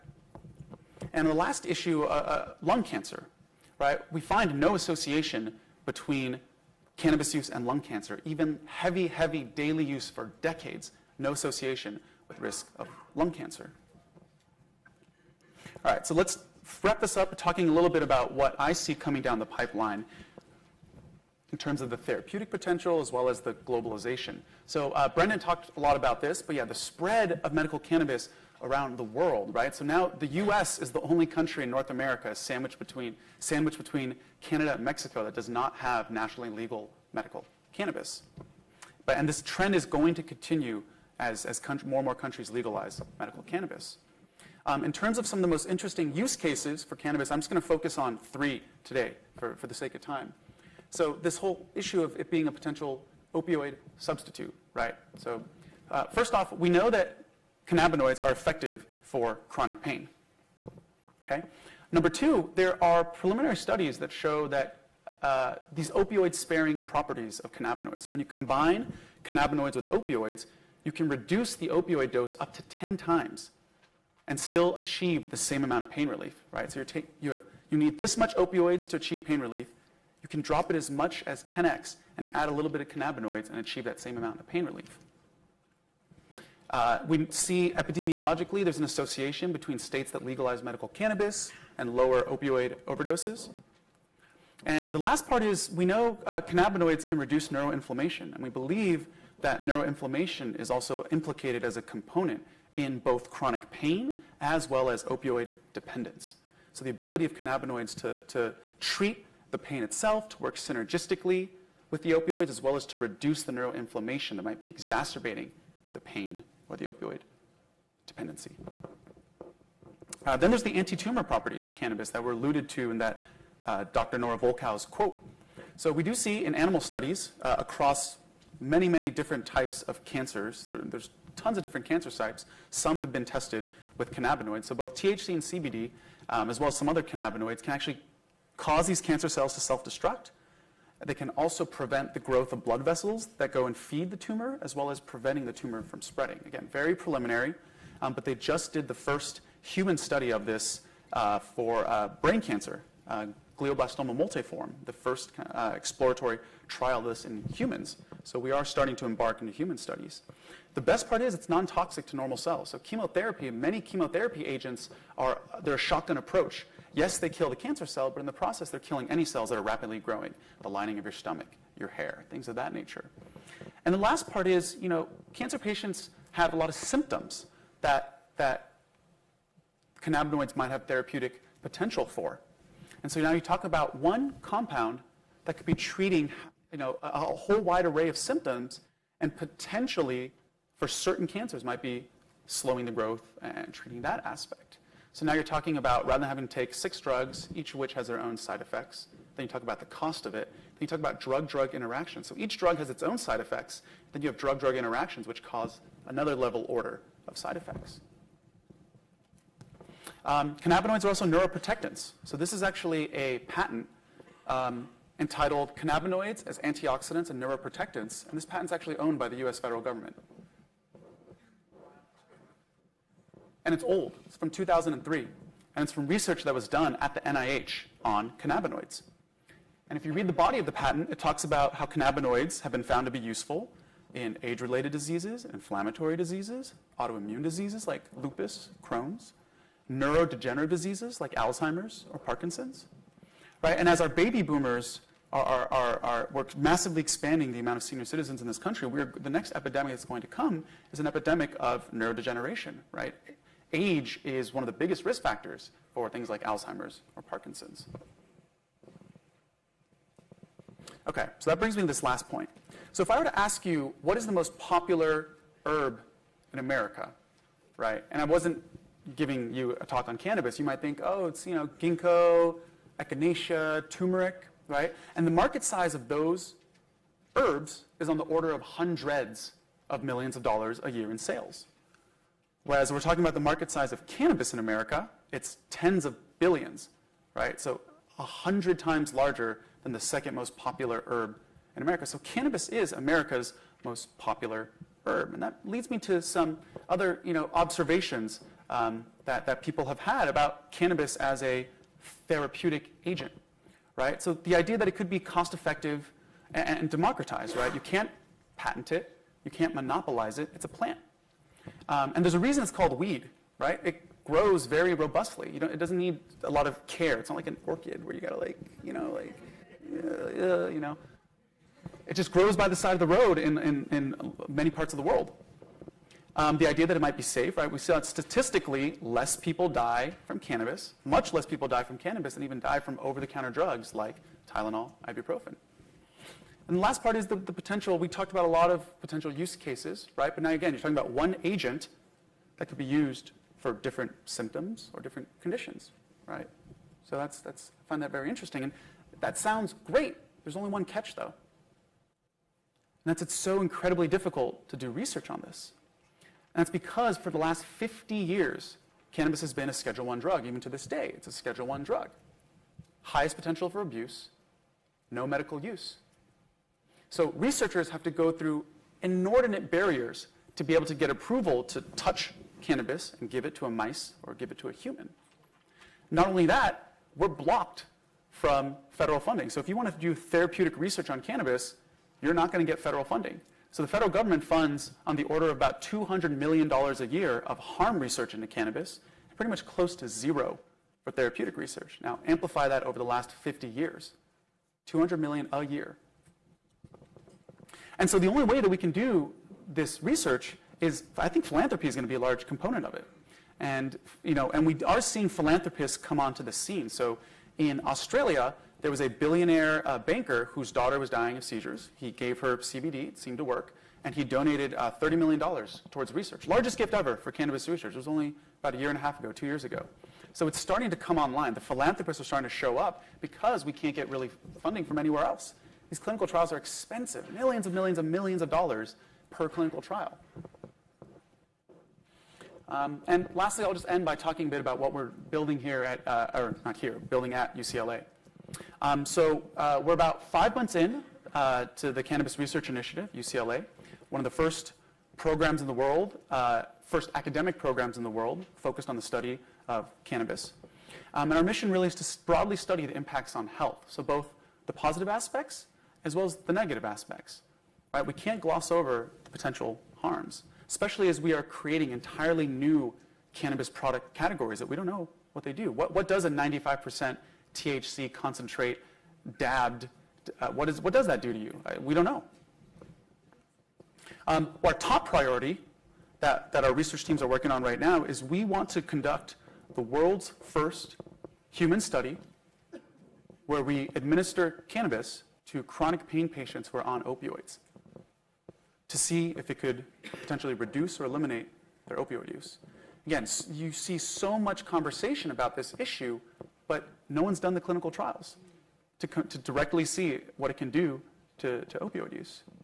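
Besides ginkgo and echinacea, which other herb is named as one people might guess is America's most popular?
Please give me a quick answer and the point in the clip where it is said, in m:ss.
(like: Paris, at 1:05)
turmeric, at 4:33.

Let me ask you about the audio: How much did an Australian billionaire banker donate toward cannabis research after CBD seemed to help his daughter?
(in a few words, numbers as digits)
$30 million.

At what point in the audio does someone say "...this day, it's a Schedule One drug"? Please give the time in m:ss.
6:00.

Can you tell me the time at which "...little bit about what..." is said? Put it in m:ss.
0:17.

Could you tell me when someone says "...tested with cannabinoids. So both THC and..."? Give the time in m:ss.
2:13.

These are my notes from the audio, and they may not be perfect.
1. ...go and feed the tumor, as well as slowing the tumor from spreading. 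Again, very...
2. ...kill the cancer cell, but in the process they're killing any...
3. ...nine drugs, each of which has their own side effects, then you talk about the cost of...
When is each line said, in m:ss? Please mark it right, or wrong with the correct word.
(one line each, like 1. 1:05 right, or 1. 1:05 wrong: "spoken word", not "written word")
1. 2:23 wrong: "preventing", not "slowing"
2. 2:47 right
3. 3:16 wrong: "six", not "nine".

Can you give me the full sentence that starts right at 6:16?
Not only that, we're blocked from federal funding.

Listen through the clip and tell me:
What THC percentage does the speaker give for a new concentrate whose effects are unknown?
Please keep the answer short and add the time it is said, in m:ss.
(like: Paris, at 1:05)
95%, at 7:46.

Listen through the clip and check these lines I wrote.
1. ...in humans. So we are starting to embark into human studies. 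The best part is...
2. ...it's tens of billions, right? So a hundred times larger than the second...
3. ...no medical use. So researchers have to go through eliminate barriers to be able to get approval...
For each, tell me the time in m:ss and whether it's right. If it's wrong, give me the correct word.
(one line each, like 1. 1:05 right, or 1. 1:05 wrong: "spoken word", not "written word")
1. 2:37 right
2. 4:45 right
3. 6:05 wrong: "inordinate", not "eliminate".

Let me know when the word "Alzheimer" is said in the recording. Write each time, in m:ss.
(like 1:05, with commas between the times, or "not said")
4:01, 4:16.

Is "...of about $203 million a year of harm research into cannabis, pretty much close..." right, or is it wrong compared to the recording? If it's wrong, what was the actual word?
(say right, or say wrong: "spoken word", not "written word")
wrong: "200", not "203".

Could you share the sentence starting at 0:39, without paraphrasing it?
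But, and this trend is going to continue as, as more and more countries legalize medical cannabis.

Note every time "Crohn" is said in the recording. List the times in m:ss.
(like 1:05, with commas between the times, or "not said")
3:58.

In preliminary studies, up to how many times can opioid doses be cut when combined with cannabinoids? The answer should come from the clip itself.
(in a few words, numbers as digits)
10 times.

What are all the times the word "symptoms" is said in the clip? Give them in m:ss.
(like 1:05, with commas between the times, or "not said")
2:56, 3:08, 5:44.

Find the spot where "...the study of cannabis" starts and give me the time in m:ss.
7:28.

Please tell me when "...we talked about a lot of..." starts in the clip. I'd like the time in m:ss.
5:37.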